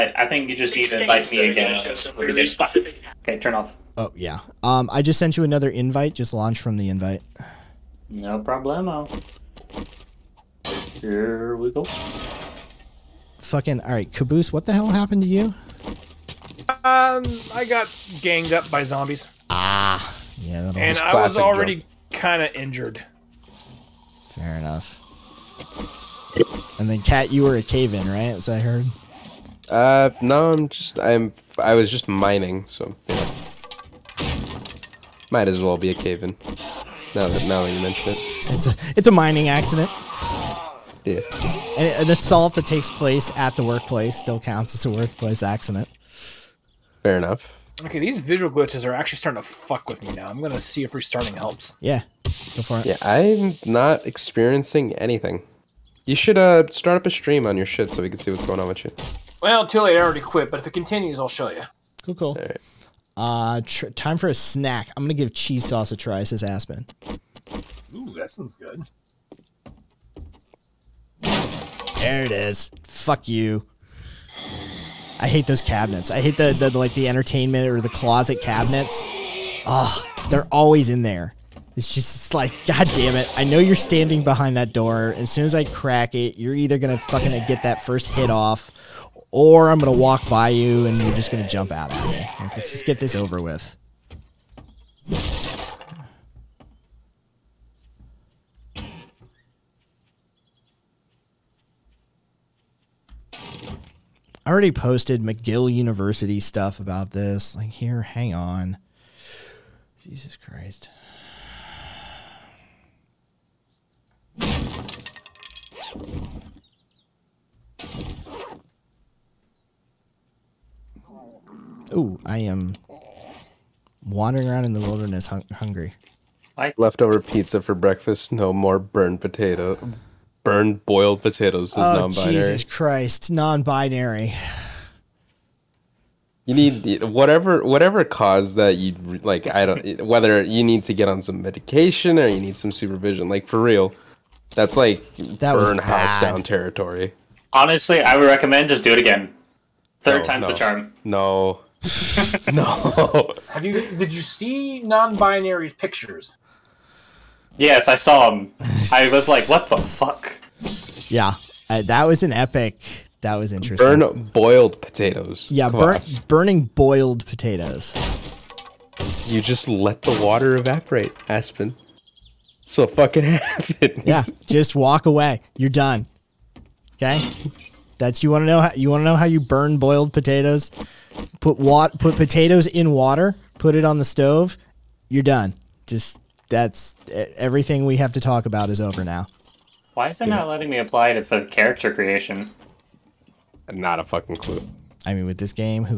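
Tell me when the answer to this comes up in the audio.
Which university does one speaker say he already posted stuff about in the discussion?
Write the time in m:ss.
1:45.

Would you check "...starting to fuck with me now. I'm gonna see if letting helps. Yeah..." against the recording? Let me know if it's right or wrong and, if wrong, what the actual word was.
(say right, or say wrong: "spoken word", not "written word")
wrong: "restarting", not "letting".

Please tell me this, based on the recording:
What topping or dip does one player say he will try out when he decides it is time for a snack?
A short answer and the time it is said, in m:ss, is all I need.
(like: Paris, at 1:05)
Cheese sauce, at 1:05.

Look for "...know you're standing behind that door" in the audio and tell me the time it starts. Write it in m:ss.
1:23.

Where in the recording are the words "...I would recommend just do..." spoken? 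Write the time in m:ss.
2:28.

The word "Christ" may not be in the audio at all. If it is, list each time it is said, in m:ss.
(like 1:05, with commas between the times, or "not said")
1:50, 2:12.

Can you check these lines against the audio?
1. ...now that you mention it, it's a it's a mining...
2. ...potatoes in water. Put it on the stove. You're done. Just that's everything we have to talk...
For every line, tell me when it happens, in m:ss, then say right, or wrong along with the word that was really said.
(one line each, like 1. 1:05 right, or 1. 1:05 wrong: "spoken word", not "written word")
1. 0:37 right
2. 3:02 right.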